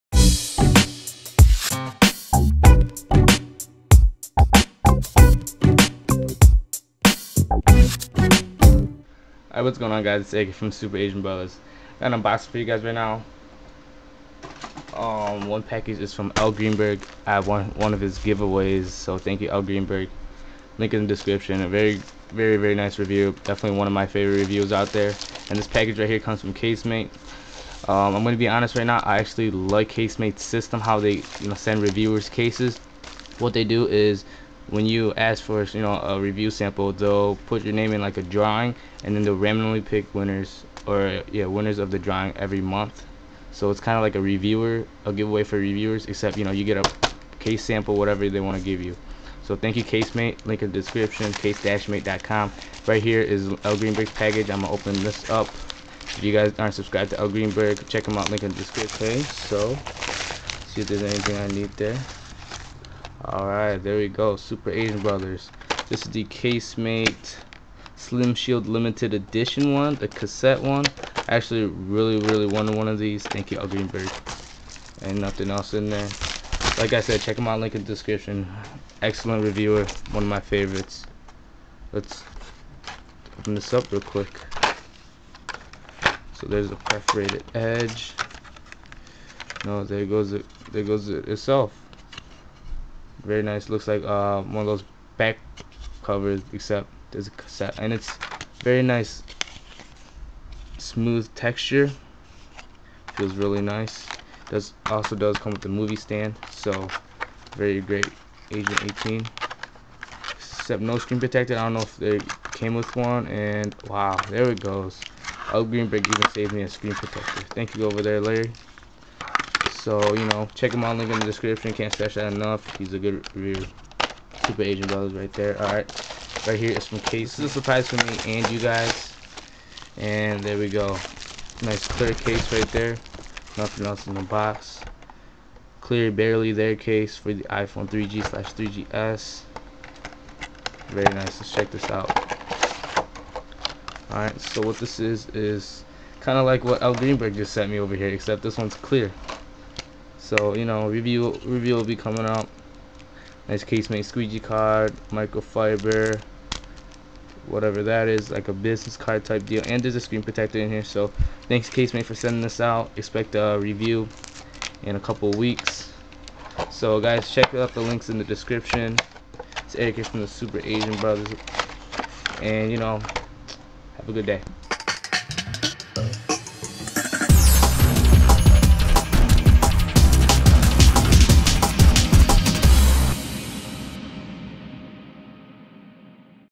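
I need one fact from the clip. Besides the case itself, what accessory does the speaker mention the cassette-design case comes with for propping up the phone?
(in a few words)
movie stand.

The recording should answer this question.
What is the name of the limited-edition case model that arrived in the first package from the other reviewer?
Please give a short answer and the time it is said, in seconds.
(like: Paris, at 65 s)
Slim Shield, at 67 s.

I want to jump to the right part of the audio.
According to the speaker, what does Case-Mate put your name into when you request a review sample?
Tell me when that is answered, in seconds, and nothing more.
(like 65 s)
38 s.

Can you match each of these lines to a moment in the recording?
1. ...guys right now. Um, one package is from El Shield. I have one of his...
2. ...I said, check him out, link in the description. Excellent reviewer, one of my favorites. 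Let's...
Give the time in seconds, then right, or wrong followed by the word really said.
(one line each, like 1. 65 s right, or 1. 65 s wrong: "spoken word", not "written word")
1. 12 s wrong: "Greenberg", not "Shield"
2. 76 s right.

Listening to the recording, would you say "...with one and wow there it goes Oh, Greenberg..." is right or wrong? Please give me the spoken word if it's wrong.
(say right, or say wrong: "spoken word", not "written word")
right.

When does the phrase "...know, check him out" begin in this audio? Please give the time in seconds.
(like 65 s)
120 s.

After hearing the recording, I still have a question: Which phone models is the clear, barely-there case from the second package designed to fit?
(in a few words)
iPhone 3G/3GS.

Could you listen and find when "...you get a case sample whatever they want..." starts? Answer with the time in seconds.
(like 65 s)
46 s.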